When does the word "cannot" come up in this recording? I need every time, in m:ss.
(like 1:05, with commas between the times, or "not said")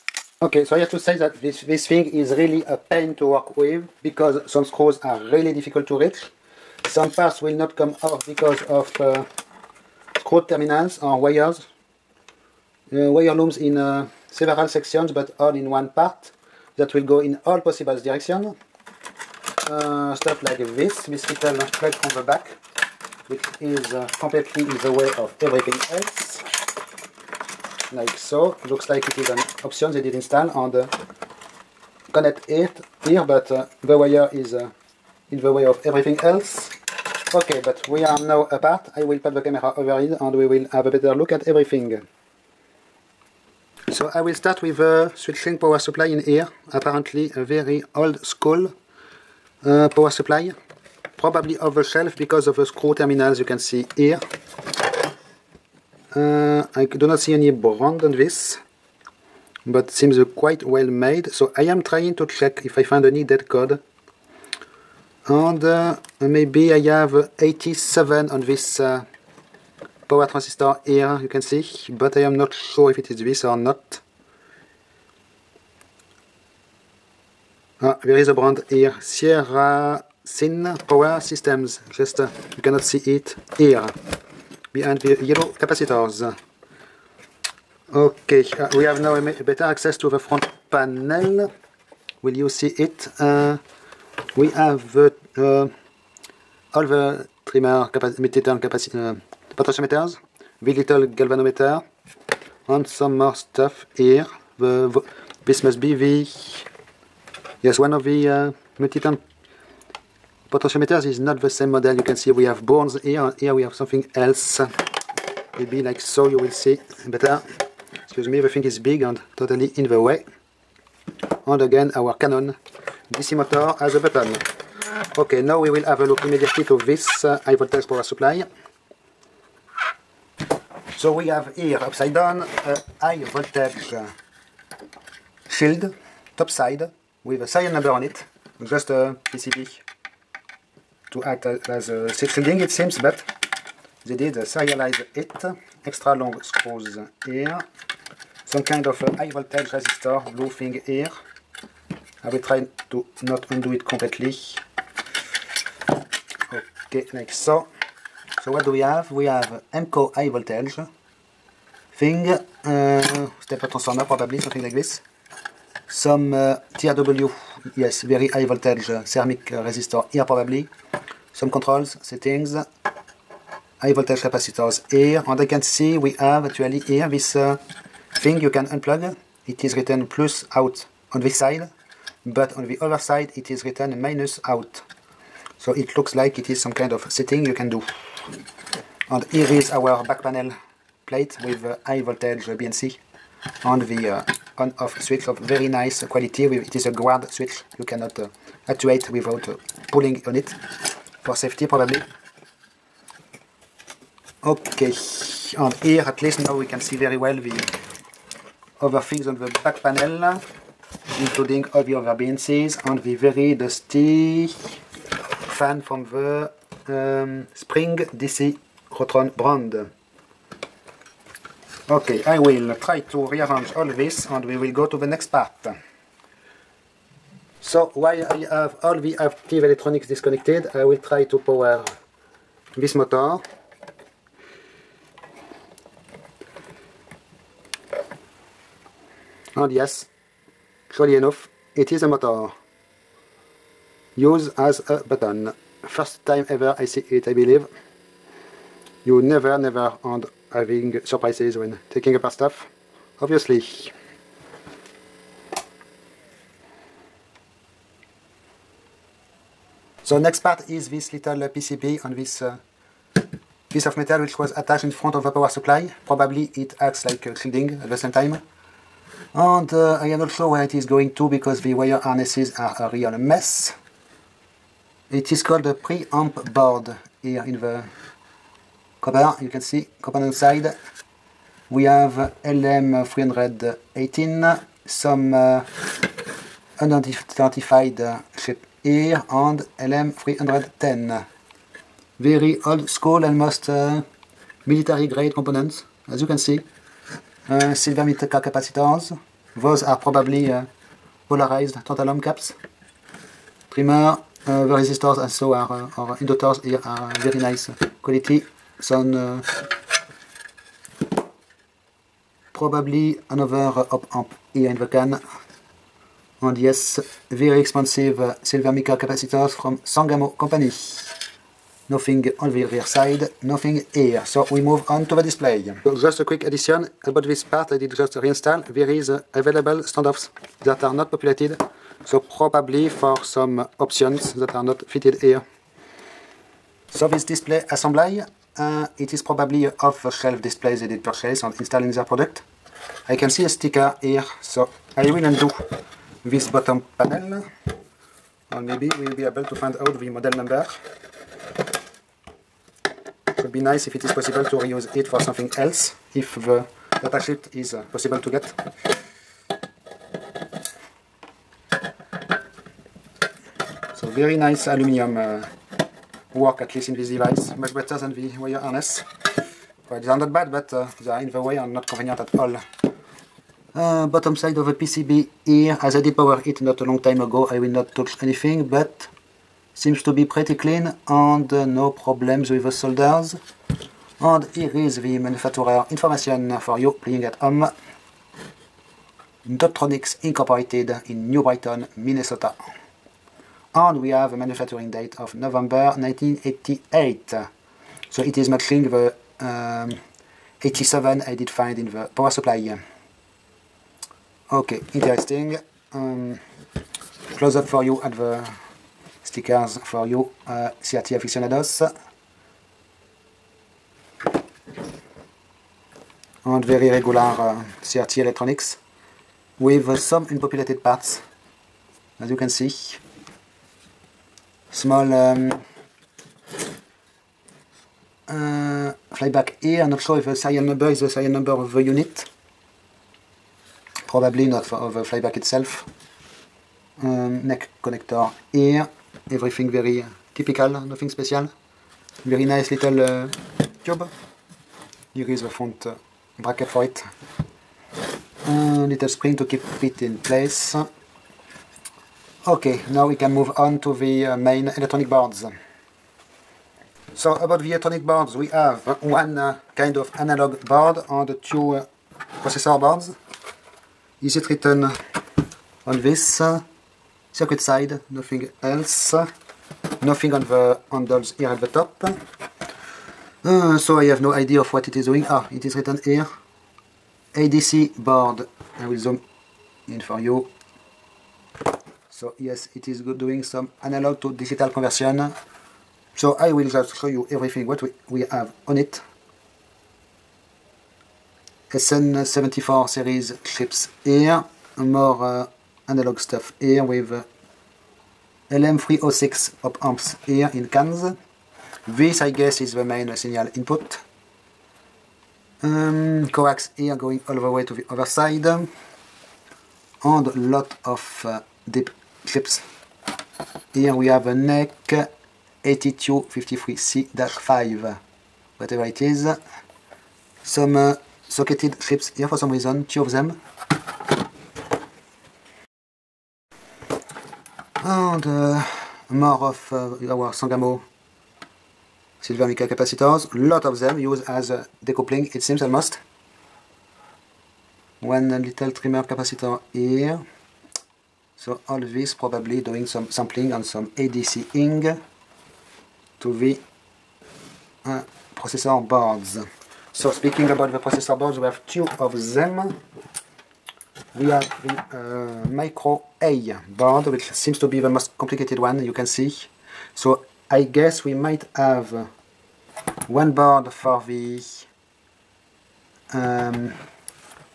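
1:22, 3:17.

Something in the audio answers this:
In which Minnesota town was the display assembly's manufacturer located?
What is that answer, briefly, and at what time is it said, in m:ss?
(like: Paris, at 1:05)
New Brighton, at 6:31.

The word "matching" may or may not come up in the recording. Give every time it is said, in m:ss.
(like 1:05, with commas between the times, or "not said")
6:38.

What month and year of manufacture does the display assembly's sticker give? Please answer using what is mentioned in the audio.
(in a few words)
November 1988.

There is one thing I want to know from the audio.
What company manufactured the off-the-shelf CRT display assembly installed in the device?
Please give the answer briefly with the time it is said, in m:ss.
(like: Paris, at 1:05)
Dotronix Incorporated, at 6:29.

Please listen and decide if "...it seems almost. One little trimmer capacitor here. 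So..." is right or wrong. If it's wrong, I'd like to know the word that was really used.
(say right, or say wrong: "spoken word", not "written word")
right.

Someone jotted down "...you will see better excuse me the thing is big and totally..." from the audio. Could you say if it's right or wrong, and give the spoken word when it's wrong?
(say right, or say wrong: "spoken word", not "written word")
right.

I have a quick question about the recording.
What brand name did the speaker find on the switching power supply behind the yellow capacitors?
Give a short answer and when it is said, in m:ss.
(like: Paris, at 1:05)
Sierra Sin Power Systems, at 1:18.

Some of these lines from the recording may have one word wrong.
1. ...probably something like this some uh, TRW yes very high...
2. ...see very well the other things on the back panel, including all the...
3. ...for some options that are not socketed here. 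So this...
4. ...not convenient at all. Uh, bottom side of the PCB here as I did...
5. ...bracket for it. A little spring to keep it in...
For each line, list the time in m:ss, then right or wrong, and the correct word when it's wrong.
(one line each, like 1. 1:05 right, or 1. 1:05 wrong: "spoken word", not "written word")
1. 2:44 right
2. 3:26 right
3. 5:32 wrong: "fitted", not "socketed"
4. 6:11 right
5. 7:26 right.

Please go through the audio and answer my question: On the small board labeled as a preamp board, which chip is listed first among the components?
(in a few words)
LM318.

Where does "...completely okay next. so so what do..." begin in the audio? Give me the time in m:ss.
2:33.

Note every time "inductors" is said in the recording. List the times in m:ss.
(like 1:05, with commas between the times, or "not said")
5:06.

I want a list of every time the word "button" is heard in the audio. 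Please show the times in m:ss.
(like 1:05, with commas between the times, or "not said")
2:03, 4:05.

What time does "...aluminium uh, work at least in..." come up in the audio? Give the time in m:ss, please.
6:04.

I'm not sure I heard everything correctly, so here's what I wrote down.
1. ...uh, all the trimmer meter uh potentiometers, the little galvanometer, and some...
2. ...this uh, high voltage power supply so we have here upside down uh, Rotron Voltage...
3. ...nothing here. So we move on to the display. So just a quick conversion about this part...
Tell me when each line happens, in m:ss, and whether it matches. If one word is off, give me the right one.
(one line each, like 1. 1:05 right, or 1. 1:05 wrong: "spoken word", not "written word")
1. 1:35 right
2. 2:06 wrong: "High", not "Rotron"
3. 5:23 wrong: "addition", not "conversion".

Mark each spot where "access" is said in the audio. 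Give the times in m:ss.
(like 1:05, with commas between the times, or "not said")
1:29.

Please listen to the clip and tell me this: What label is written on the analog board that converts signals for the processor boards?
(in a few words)
ADC board.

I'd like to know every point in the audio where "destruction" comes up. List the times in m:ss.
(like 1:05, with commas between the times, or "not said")
not said.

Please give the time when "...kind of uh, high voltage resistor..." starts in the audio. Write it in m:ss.
2:28.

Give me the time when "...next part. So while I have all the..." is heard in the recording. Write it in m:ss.
3:45.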